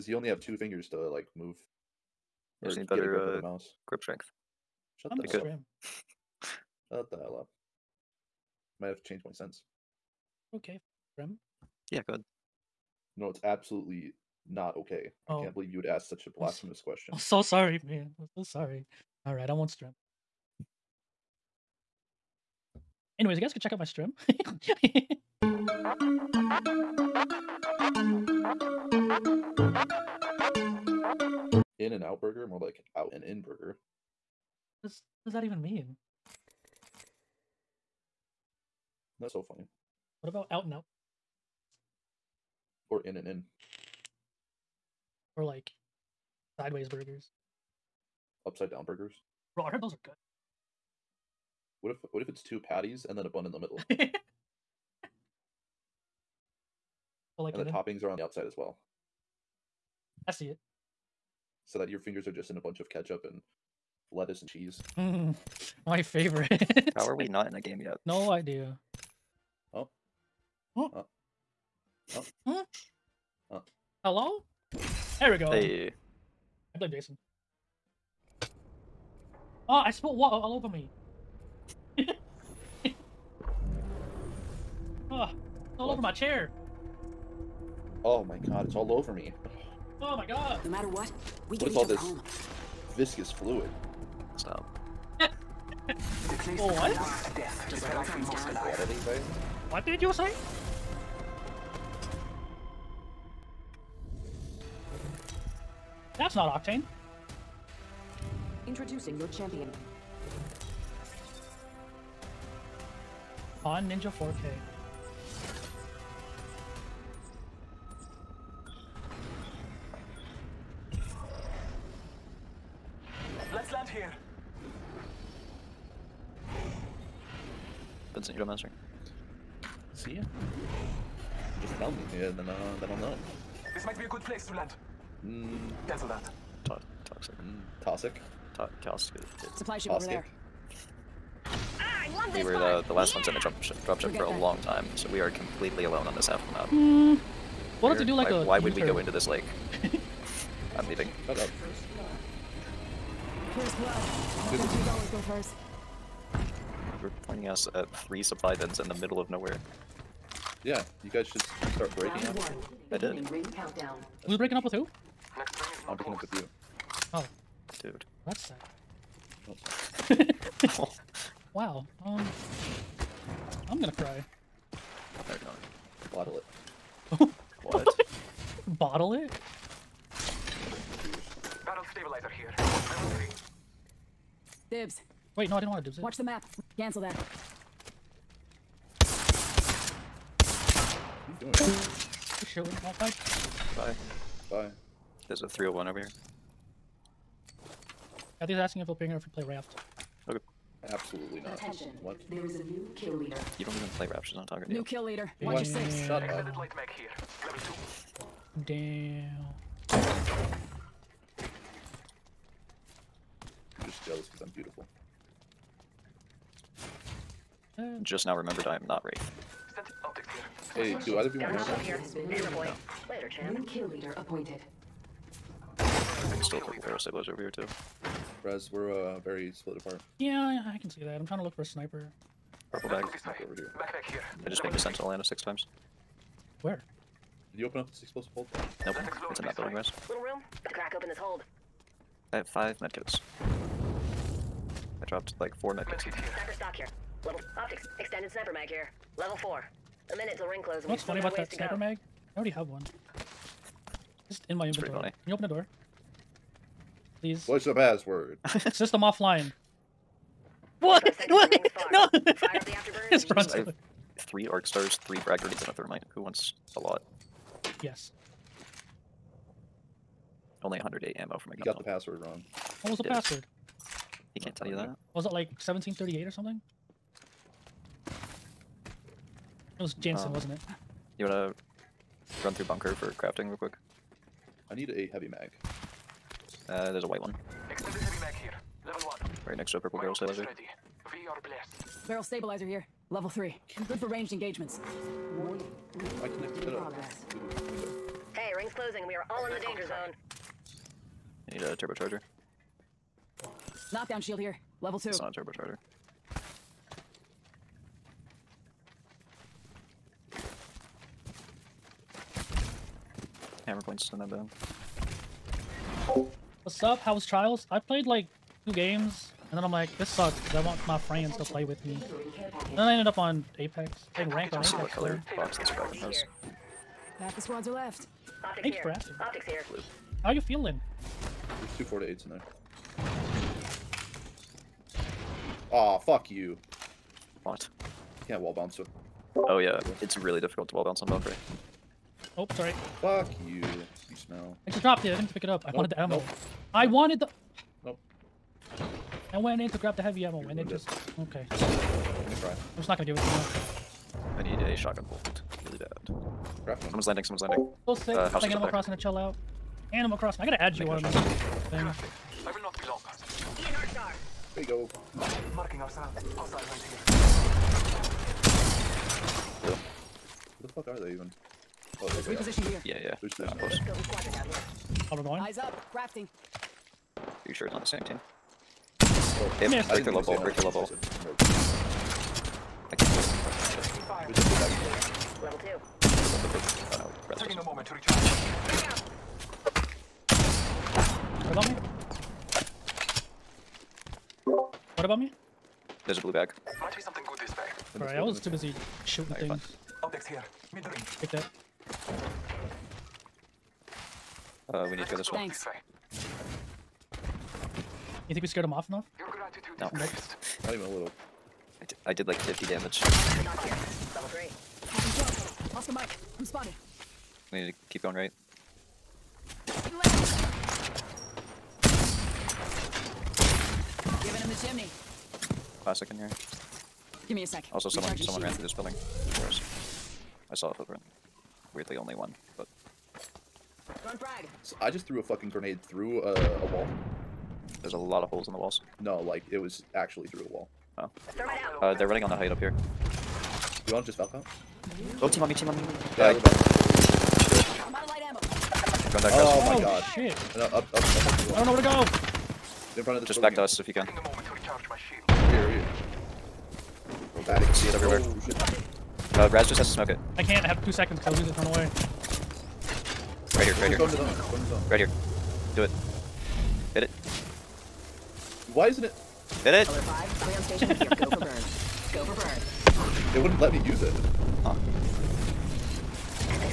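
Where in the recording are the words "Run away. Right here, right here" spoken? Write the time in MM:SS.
07:41.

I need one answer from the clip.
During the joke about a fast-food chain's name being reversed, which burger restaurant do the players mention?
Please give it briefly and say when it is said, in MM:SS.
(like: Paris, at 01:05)
In and Out Burger, at 00:31.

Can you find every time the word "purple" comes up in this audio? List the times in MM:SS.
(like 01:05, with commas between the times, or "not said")
03:46, 03:52, 04:49.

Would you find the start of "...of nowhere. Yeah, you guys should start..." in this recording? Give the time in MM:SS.
02:39.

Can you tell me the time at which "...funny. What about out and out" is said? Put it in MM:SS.
00:39.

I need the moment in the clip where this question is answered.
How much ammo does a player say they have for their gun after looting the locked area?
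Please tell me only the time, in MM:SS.
04:30.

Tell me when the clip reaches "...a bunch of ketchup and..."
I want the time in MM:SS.
01:02.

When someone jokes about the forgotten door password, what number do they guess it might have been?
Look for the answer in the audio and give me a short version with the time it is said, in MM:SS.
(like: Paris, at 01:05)
1738, at 04:35.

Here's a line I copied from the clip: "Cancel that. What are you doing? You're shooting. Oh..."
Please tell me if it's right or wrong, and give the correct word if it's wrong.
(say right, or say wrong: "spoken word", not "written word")
right.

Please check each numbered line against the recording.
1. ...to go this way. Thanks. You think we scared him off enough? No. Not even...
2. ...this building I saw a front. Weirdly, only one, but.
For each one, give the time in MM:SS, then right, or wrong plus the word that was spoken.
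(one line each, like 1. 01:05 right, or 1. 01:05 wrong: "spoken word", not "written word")
1. 06:45 right
2. 07:08 wrong: "footprint", not "front".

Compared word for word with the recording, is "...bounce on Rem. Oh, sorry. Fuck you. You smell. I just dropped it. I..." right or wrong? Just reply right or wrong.
wrong.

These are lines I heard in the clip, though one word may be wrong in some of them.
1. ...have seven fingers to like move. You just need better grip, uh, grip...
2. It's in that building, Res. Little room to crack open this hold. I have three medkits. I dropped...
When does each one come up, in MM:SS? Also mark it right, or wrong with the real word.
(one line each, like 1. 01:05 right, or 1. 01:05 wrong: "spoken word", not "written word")
1. 00:00 wrong: "two", not "seven"
2. 03:59 wrong: "five", not "three".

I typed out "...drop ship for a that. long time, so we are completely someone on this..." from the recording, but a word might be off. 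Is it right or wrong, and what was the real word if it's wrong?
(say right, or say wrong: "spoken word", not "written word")
wrong: "alone", not "someone".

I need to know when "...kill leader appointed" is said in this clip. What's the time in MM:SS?
03:43.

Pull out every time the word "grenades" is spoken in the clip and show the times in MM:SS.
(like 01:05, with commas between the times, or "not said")
04:25, 07:15.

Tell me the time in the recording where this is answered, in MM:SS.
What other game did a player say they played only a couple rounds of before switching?
05:17.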